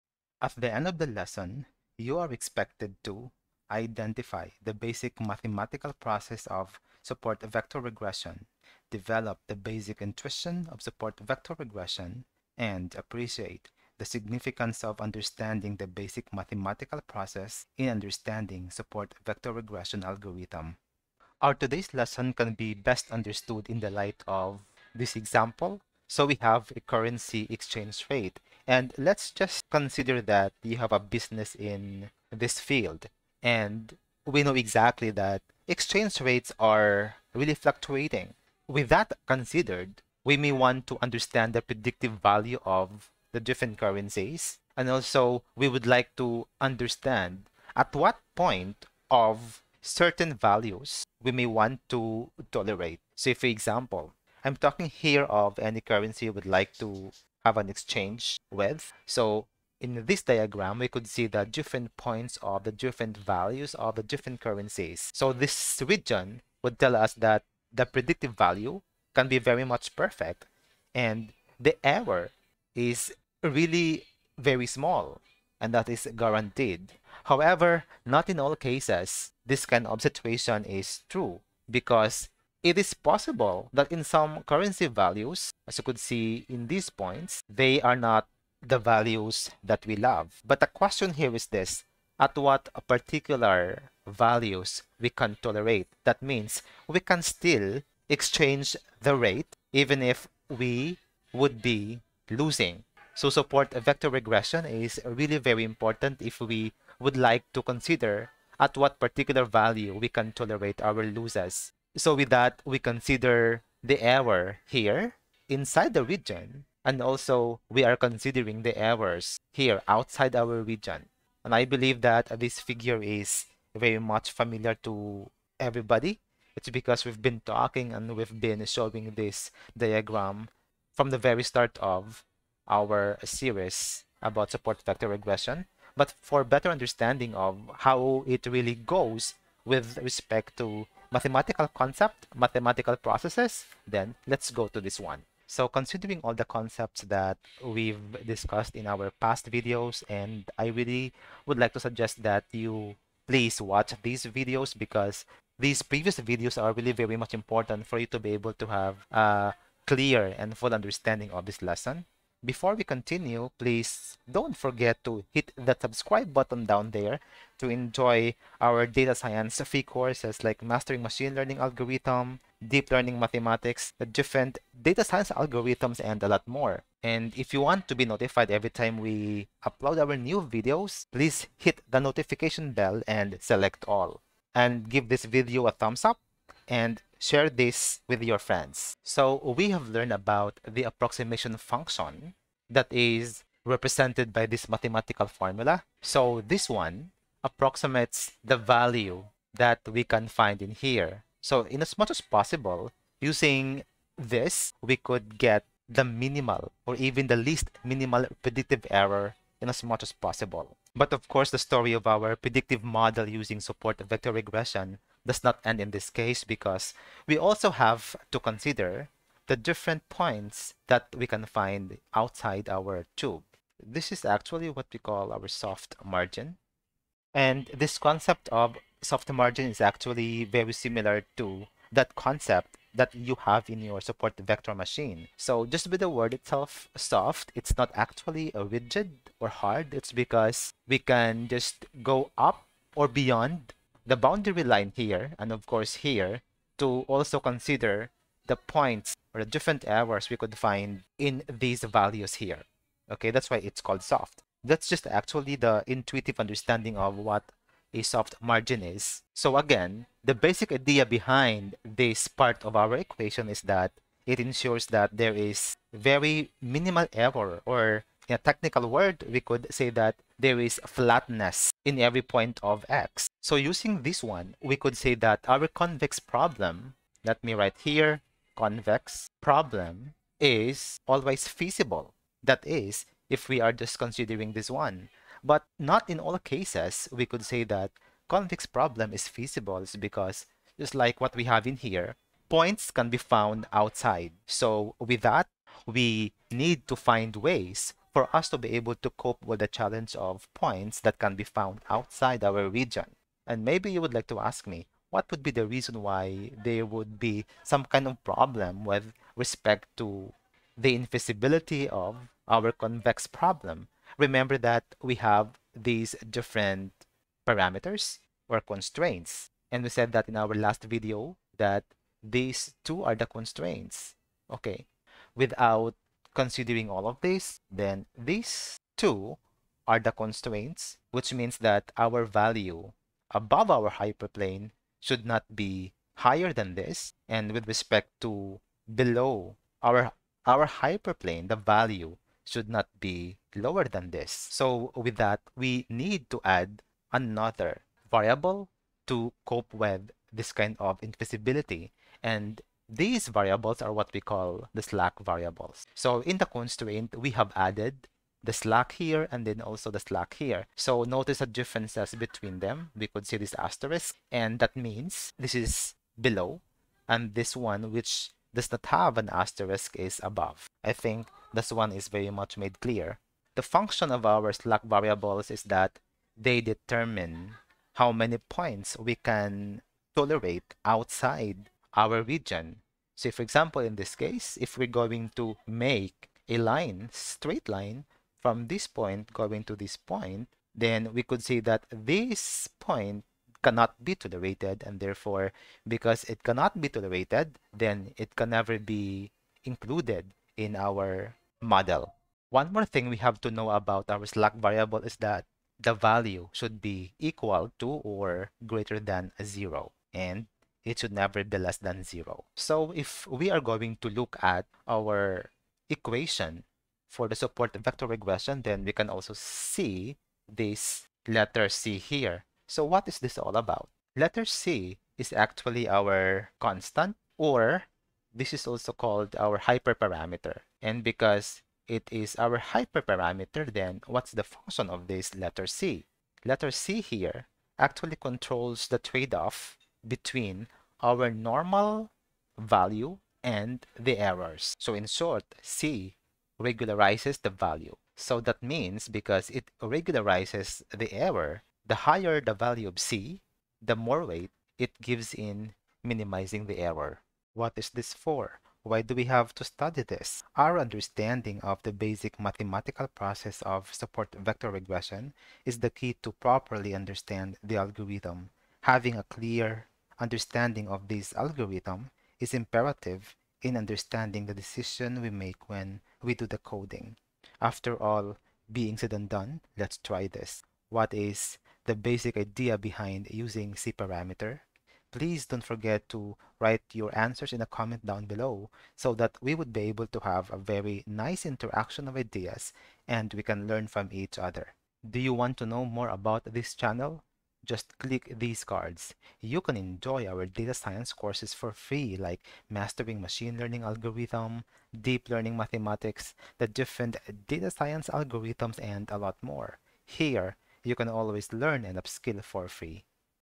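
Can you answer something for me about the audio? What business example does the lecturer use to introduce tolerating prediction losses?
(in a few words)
Currency exchange rate.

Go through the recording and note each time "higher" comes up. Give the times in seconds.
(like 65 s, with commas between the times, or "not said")
336 s, 452 s.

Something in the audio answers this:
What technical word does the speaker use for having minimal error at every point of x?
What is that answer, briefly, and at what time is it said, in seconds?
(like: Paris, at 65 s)
Flatness, at 270 s.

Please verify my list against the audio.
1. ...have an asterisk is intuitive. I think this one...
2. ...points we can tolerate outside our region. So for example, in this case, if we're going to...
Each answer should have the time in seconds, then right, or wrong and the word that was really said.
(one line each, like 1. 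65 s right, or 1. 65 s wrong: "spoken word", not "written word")
1. 368 s wrong: "above", not "intuitive"
2. 378 s right.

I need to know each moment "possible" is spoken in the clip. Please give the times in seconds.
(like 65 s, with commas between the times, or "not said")
82 s, 202 s, 210 s.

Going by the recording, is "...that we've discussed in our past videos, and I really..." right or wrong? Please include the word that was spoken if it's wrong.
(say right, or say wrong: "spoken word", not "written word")
right.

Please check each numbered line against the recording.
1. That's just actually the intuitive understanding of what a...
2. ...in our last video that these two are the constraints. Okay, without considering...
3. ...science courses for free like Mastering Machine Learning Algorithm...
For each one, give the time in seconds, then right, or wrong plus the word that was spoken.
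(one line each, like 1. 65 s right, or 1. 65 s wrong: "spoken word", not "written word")
1. 254 s right
2. 320 s right
3. 500 s right.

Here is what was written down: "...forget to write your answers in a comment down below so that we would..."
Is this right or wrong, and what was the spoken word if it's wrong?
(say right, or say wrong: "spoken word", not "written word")
right.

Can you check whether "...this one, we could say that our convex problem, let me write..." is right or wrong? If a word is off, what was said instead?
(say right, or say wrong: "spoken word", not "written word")
right.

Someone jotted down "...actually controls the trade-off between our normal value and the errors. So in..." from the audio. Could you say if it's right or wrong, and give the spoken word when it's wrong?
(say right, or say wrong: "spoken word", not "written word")
right.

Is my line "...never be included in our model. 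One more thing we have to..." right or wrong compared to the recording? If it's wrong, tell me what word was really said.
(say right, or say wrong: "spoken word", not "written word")
right.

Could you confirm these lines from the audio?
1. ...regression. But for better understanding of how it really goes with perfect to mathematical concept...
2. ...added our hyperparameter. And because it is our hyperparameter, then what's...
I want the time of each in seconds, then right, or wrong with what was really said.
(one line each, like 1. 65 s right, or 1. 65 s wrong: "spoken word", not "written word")
1. 135 s wrong: "respect", not "perfect"
2. 428 s wrong: "called", not "added".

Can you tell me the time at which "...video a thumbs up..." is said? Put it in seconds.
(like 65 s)
185 s.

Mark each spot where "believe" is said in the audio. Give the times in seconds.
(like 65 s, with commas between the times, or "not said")
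121 s.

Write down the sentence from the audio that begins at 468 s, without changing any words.
Having a clear understanding of this algorithm is imperative in understanding the decision we make when we do the coding.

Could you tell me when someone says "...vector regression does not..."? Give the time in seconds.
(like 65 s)
213 s.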